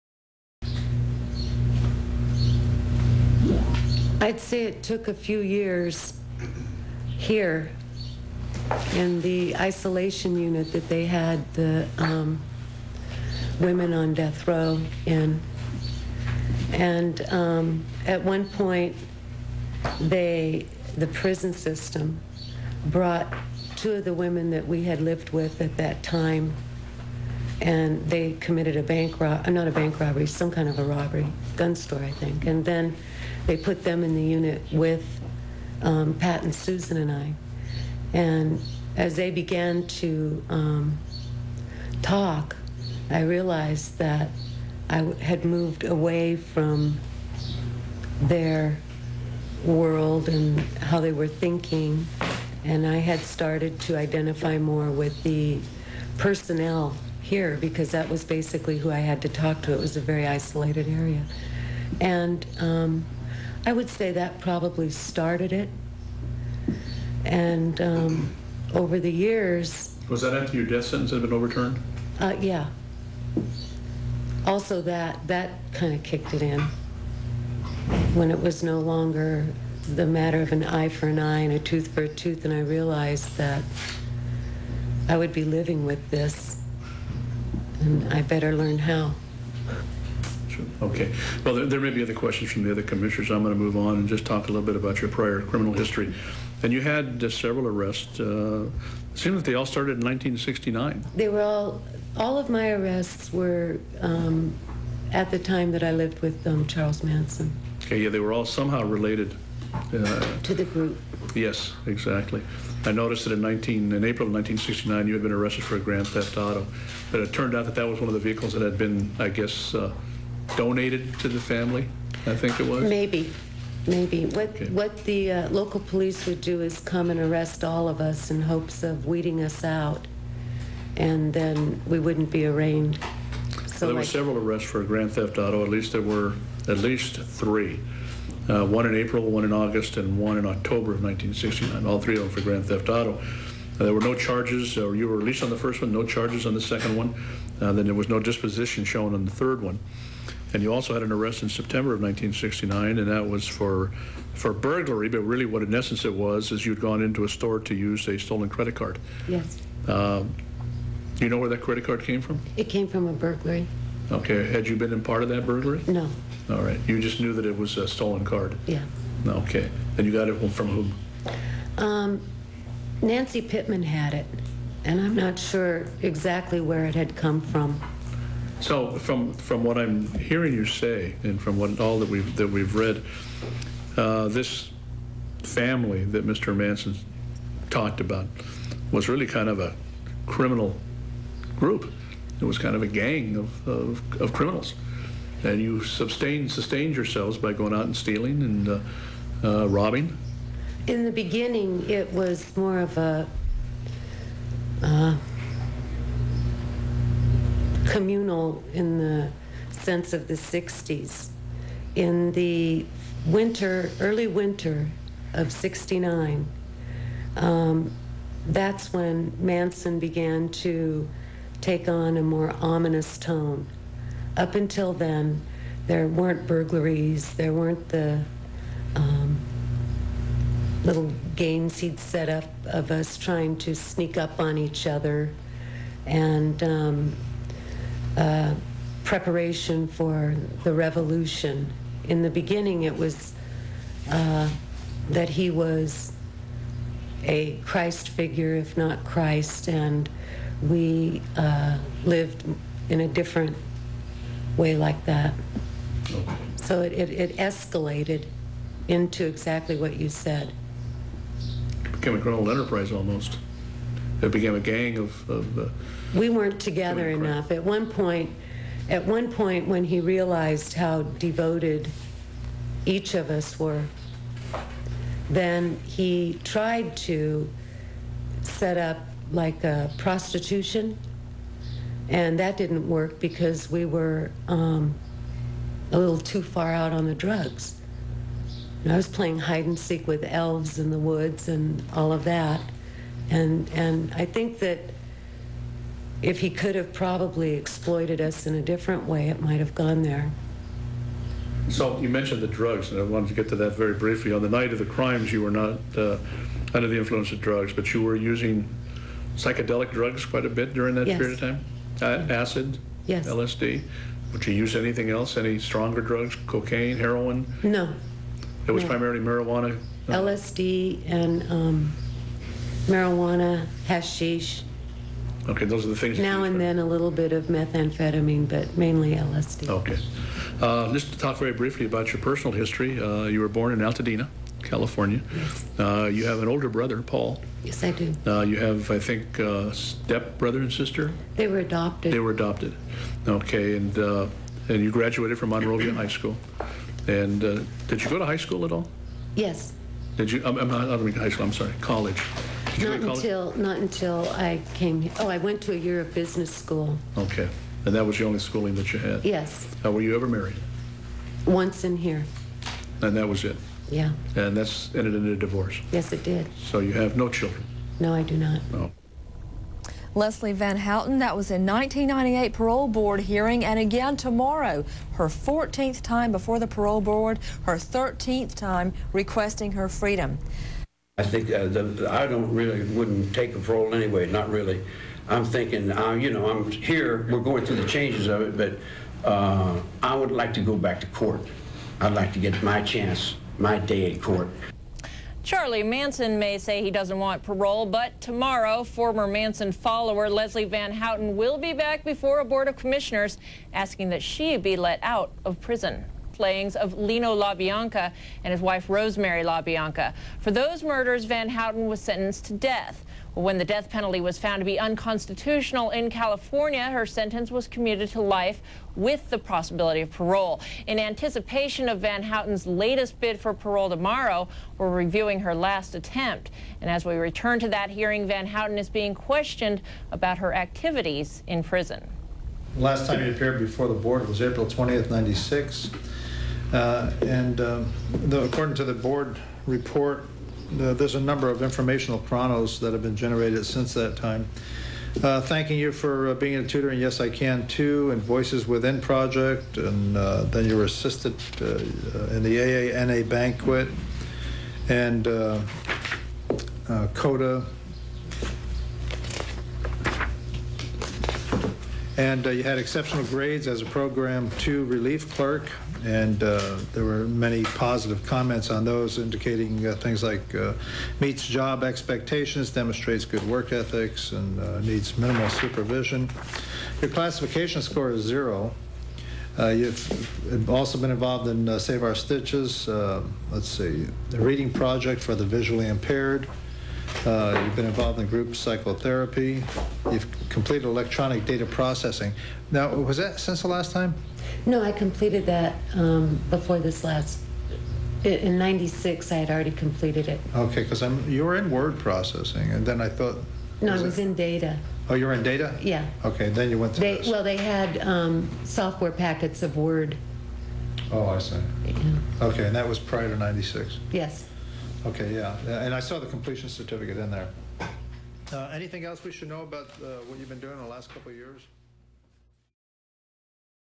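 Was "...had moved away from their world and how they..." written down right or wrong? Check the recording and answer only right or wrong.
right.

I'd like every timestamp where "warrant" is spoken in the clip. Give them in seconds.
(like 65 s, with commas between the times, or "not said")
not said.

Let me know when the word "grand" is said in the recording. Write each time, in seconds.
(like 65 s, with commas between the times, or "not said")
115 s, 134 s, 142 s.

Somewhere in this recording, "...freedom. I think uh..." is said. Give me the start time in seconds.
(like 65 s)
379 s.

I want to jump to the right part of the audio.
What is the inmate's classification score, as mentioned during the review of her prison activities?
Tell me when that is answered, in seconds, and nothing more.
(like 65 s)
478 s.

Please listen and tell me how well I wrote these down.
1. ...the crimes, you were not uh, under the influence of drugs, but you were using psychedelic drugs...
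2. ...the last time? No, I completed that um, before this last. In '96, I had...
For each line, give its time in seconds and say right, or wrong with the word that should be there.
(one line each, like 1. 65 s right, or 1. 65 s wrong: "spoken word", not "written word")
1. 304 s right
2. 493 s right.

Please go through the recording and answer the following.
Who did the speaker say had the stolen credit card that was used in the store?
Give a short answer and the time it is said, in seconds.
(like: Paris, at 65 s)
Nancy Pitman, at 173 s.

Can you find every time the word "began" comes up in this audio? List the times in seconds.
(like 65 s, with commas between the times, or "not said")
39 s, 219 s.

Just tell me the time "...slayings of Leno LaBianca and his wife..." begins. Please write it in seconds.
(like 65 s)
406 s.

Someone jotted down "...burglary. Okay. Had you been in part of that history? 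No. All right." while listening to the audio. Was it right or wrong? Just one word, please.
wrong.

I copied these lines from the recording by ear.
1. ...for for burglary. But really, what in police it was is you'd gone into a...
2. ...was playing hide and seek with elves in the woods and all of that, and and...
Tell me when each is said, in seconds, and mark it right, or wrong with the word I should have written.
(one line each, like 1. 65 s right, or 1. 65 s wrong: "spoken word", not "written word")
1. 153 s wrong: "essence", not "police"
2. 288 s right.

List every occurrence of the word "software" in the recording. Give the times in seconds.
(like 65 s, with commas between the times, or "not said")
508 s.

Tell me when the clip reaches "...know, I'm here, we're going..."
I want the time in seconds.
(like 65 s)
386 s.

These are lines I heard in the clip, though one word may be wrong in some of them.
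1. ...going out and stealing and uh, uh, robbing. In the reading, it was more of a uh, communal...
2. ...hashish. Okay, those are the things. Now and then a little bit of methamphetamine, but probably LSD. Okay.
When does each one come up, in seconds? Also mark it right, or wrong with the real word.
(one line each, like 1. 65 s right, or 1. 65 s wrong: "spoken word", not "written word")
1. 197 s wrong: "beginning", not "reading"
2. 323 s wrong: "mainly", not "probably".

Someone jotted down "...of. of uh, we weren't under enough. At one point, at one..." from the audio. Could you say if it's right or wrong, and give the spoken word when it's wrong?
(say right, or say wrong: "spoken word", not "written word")
wrong: "together", not "under".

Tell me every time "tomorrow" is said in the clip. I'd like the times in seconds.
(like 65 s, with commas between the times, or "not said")
374 s, 398 s, 423 s.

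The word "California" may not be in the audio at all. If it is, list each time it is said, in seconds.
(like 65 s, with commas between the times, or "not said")
334 s, 416 s.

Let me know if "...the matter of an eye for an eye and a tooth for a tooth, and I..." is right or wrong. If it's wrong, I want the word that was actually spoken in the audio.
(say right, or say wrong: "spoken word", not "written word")
right.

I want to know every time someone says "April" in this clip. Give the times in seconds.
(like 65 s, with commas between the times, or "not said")
114 s, 138 s, 434 s.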